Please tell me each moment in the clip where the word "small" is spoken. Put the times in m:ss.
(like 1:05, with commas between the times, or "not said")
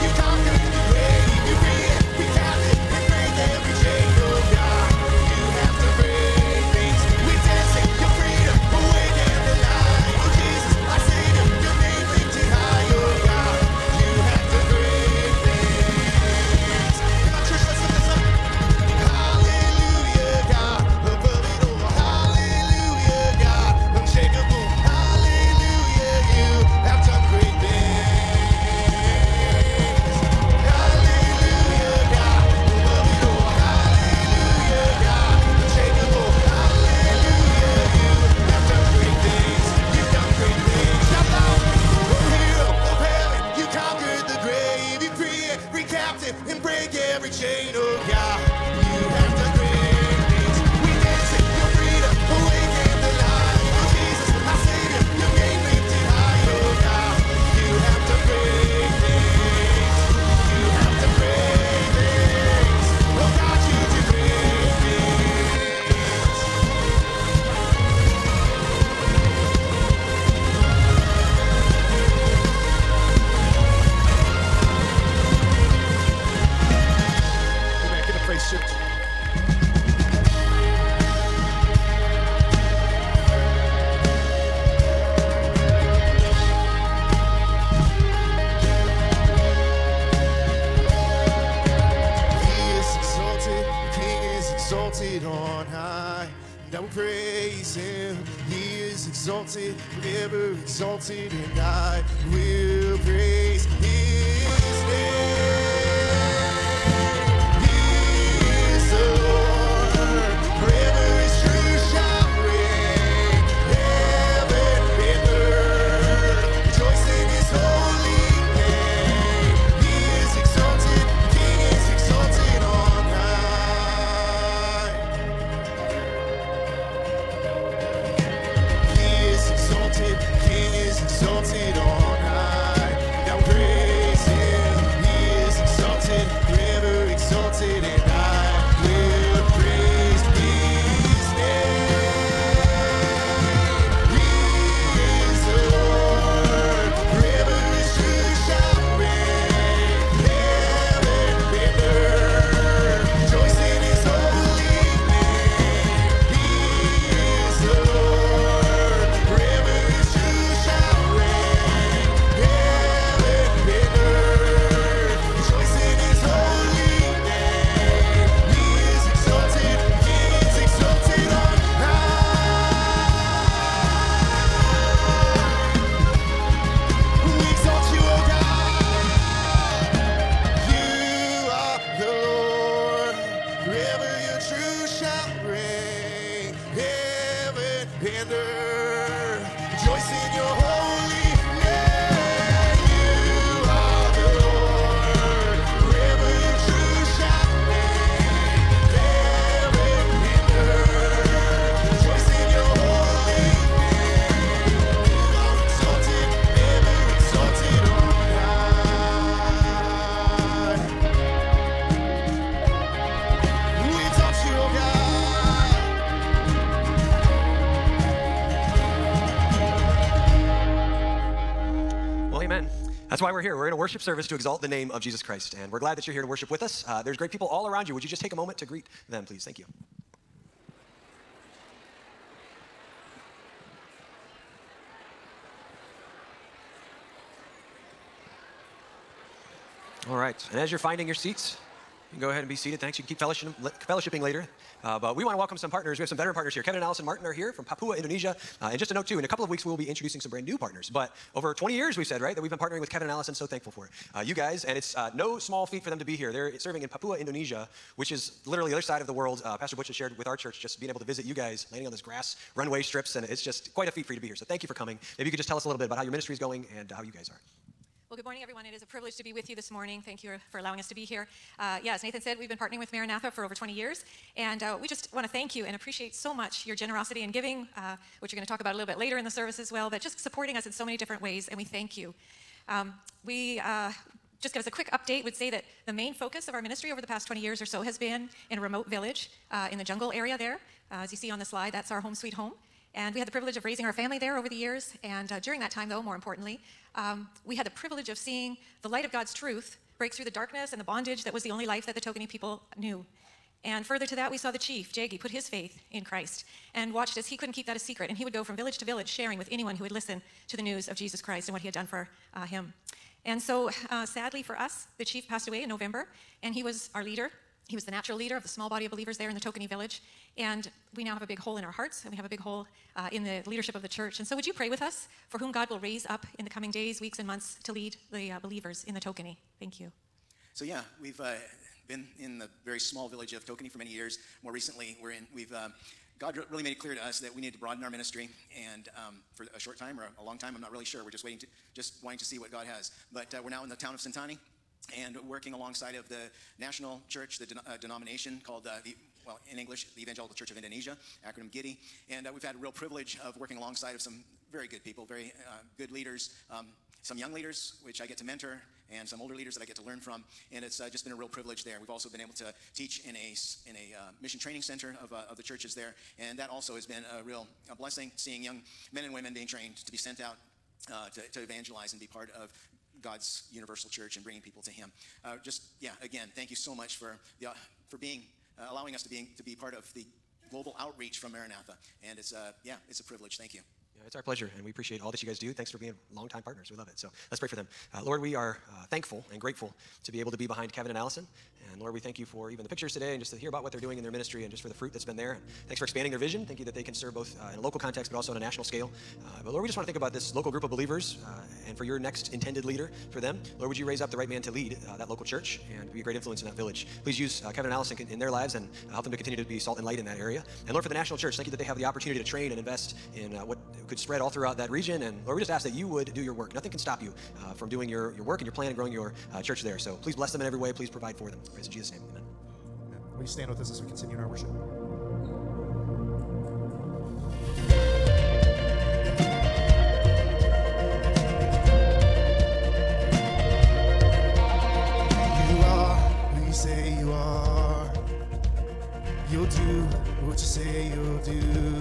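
4:15, 5:18, 5:32.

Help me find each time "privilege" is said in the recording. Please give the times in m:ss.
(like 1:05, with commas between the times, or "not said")
4:28, 4:53, 4:57, 5:52, 6:01, 6:23.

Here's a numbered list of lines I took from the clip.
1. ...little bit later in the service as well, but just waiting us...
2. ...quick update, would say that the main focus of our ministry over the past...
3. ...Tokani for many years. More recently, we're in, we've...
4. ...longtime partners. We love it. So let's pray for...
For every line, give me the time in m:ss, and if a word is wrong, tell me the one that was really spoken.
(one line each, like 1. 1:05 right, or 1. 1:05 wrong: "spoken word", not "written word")
1. 4:38 wrong: "supporting", not "waiting"
2. 4:44 right
3. 5:33 right
4. 6:26 right.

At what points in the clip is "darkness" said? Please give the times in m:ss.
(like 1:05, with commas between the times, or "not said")
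5:00.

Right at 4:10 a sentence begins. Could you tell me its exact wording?
But over 20 years, we've said, right, that we've been partnering with Kevin and Allison.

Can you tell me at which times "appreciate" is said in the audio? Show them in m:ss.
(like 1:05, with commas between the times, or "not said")
4:35, 6:24.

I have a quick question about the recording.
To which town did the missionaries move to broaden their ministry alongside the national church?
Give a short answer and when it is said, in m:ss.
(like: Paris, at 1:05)
Sentani, at 5:43.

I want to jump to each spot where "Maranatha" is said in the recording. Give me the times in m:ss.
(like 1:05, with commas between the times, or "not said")
4:32, 6:21.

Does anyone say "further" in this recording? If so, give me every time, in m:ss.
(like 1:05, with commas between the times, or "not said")
5:03.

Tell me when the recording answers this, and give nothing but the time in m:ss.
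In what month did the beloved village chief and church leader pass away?
5:15.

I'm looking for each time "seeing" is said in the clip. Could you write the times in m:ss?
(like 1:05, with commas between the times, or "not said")
4:58, 6:08.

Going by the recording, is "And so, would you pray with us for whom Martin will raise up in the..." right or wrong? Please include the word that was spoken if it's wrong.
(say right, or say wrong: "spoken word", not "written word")
wrong: "God", not "Martin".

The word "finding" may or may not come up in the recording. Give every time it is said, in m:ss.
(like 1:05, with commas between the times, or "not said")
4:00.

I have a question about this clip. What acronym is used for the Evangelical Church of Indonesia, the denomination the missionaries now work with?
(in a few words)
GIDI.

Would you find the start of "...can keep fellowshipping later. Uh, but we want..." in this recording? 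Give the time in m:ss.
4:03.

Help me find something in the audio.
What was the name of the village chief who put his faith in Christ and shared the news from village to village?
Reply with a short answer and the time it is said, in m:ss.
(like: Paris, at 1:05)
Jagi, at 5:04.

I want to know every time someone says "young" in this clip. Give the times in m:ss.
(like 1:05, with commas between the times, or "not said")
5:57, 6:08.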